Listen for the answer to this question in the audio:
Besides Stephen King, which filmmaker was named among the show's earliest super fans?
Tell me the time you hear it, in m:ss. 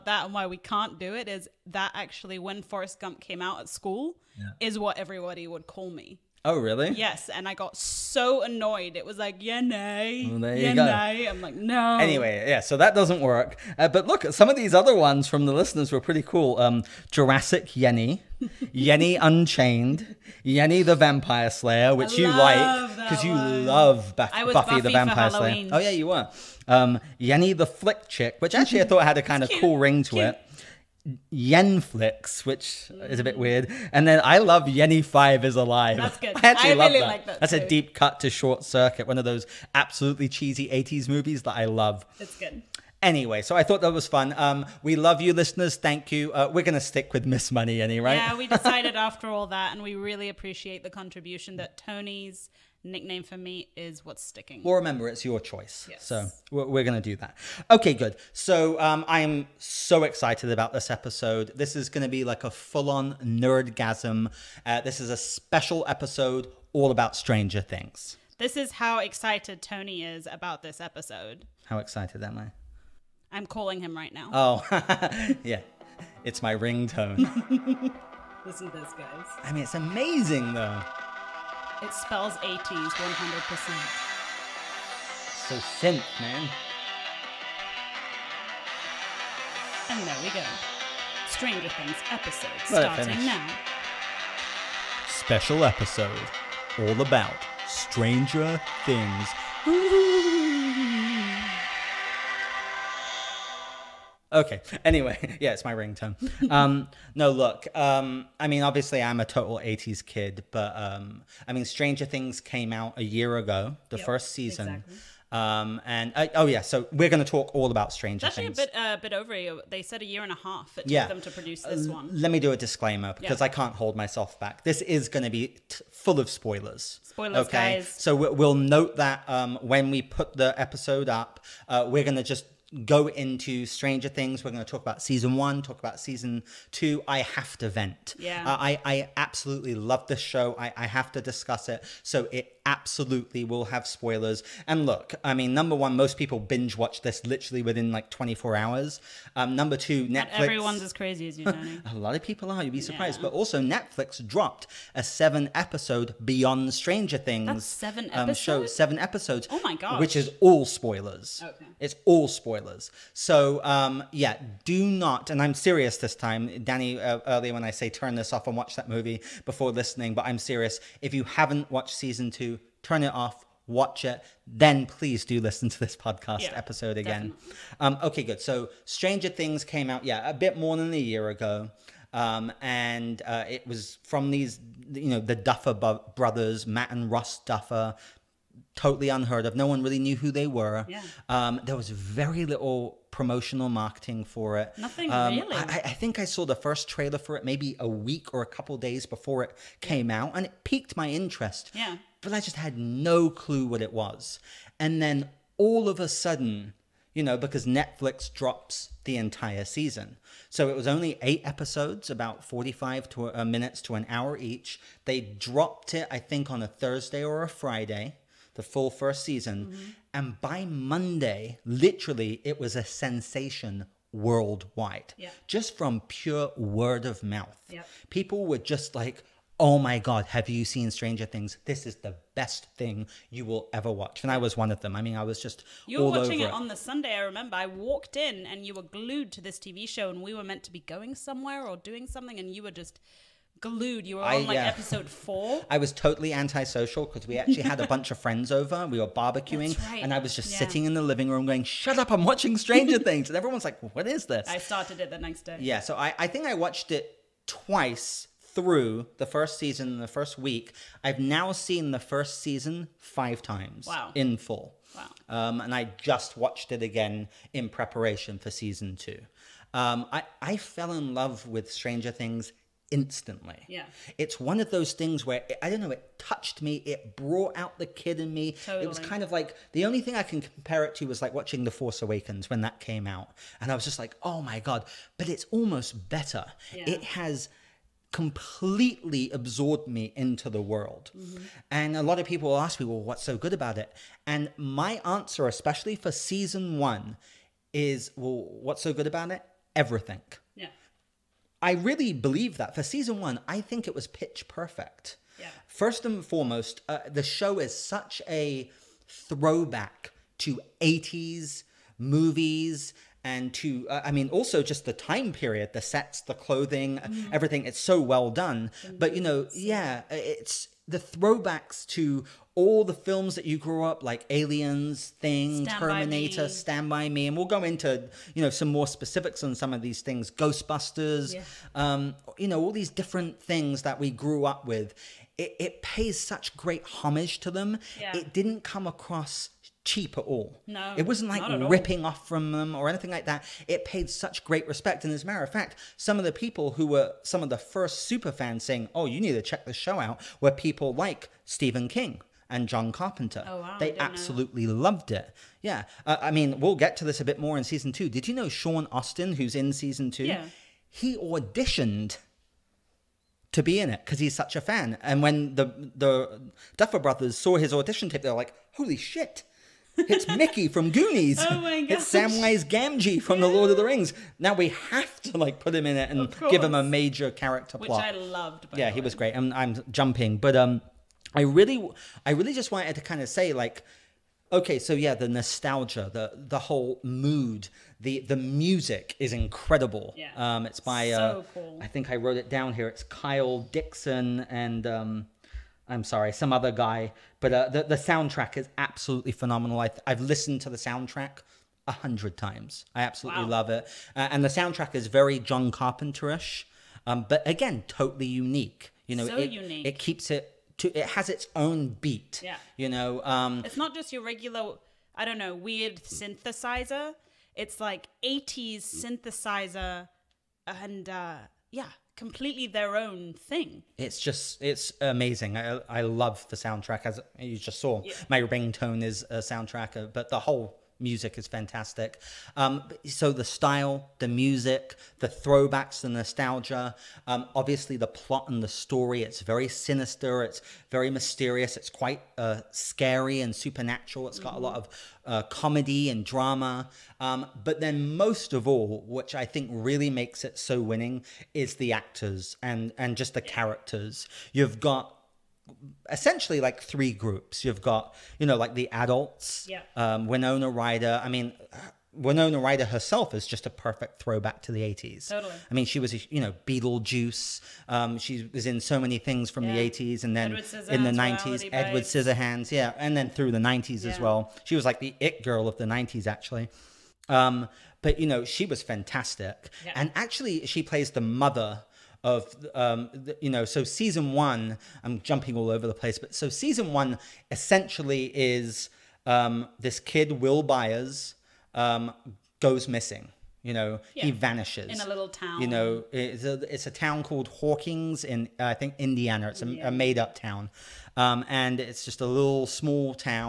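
5:52.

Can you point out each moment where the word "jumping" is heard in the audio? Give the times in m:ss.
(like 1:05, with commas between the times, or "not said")
6:19, 8:05.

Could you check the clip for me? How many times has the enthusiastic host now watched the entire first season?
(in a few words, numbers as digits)
5.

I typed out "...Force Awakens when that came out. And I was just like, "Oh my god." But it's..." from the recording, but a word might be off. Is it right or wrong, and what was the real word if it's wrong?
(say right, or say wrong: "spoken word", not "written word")
right.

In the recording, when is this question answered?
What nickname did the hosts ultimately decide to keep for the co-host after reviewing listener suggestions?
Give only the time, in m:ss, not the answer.
0:47.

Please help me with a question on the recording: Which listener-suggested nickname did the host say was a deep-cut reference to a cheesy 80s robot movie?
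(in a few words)
Yenny Five is Alive.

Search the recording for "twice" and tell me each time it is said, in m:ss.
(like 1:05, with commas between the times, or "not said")
4:17.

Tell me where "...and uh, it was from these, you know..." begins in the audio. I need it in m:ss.
3:02.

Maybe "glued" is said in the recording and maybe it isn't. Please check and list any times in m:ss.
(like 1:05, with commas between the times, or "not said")
3:58, 4:03.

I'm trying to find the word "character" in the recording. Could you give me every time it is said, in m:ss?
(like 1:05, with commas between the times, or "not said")
6:17, 7:33.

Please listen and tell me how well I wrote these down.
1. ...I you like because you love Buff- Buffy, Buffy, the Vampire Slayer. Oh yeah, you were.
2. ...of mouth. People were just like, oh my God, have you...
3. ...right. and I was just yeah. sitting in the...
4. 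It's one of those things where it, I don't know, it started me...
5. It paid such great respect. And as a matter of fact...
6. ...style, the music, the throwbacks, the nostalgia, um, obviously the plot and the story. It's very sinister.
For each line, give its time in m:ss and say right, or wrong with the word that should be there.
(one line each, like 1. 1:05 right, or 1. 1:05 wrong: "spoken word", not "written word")
1. 0:22 right
2. 3:47 right
3. 4:09 right
4. 4:34 wrong: "touched", not "started"
5. 5:43 right
6. 7:13 right.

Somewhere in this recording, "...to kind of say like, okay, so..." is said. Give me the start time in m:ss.
6:22.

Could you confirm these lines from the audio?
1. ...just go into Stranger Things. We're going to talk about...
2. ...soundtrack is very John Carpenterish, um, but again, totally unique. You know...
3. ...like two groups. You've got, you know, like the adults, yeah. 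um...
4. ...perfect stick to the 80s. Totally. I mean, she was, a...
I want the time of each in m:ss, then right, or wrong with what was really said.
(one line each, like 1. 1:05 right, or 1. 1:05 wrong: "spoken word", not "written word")
1. 2:12 right
2. 6:44 right
3. 7:36 wrong: "three", not "two"
4. 7:43 wrong: "throwback", not "stick".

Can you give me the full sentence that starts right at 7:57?
Um, but, you know, she was fantastic.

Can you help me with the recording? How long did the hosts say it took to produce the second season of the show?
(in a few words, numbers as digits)
a year and a half.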